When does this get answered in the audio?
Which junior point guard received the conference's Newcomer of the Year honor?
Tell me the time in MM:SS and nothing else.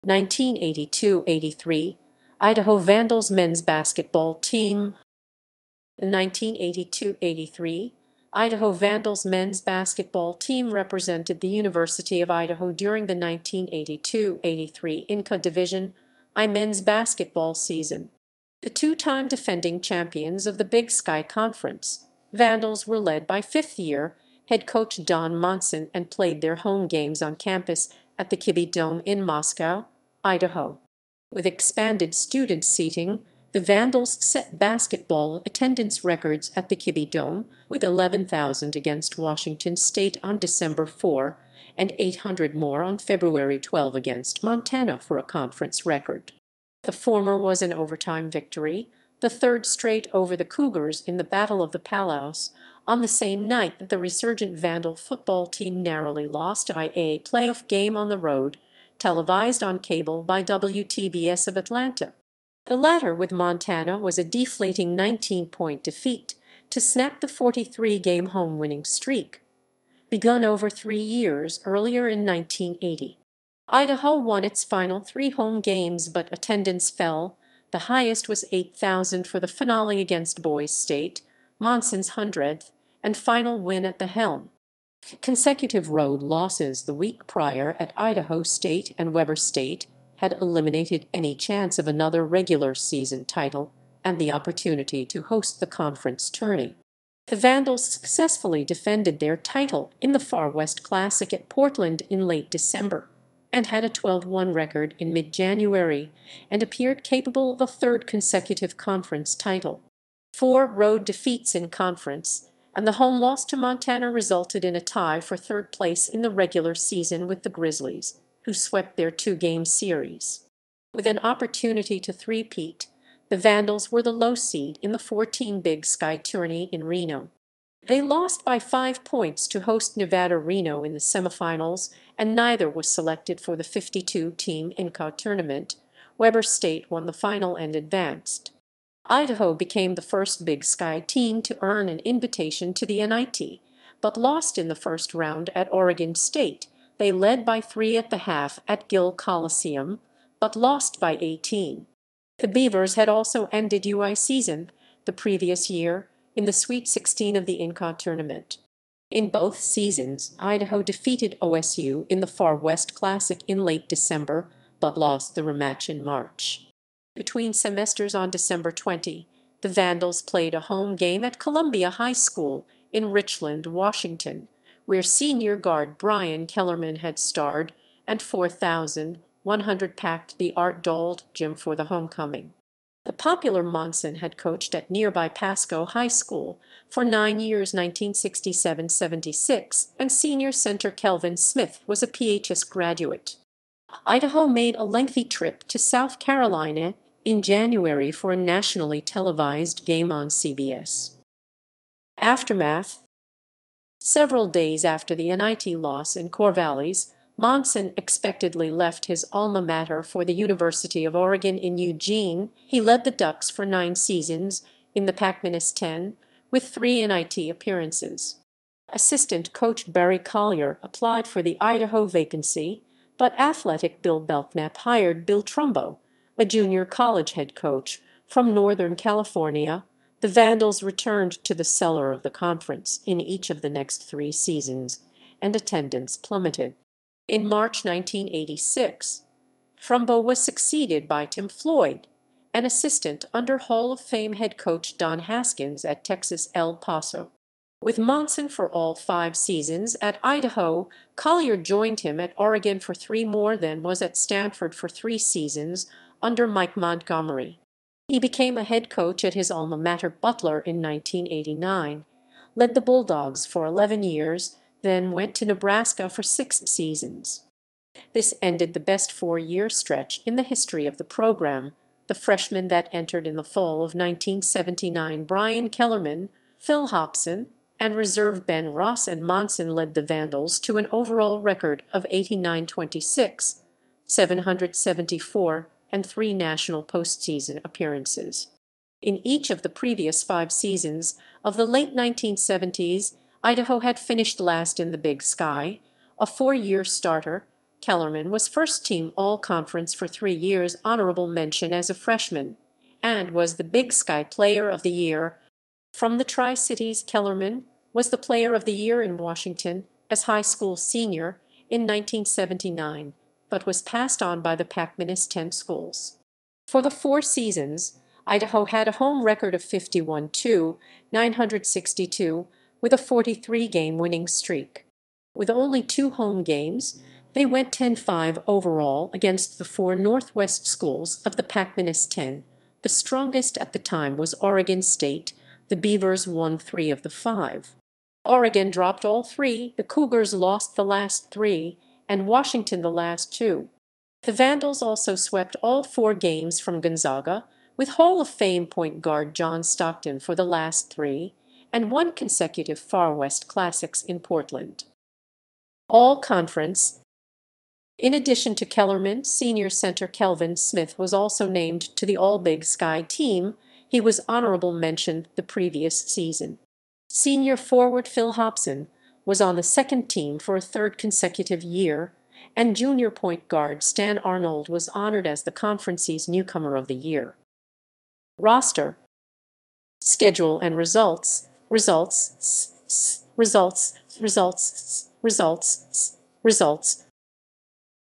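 06:13.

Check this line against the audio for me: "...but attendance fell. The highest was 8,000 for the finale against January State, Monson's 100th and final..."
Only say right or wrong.
wrong.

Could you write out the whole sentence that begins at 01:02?
The latter with Montana was a deflating 19-point defeat to snap the 43-game home-winning streak, begun over three years earlier in 1980.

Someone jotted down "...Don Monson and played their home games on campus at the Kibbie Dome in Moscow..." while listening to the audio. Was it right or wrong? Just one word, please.
right.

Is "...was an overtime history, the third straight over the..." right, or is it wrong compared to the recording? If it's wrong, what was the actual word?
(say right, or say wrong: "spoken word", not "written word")
wrong: "victory", not "history".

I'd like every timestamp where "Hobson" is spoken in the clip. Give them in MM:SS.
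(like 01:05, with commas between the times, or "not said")
04:36, 06:08.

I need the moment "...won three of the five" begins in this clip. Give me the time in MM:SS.
05:36.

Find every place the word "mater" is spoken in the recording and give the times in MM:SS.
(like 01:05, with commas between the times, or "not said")
03:29, 04:19.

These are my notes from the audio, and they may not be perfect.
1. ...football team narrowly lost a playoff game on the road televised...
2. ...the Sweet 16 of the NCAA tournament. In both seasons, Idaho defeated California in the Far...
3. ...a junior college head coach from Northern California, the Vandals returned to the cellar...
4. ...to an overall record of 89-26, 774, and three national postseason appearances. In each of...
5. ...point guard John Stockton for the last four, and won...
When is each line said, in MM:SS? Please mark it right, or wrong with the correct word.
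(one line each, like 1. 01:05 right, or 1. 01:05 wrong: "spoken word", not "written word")
1. 00:54 right
2. 02:36 wrong: "OSU", not "California"
3. 03:46 right
4. 04:40 right
5. 05:48 wrong: "three", not "four".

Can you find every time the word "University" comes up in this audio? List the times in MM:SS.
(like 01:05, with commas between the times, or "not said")
00:11, 03:30.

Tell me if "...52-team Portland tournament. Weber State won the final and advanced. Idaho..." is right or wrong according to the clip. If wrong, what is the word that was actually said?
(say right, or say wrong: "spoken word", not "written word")
wrong: "NCAA", not "Portland".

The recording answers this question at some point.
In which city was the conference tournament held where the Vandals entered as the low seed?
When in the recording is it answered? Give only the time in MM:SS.
02:06.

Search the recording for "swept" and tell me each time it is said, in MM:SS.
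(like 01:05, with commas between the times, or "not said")
01:58, 05:45.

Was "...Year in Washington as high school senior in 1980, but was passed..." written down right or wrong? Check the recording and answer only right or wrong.
wrong.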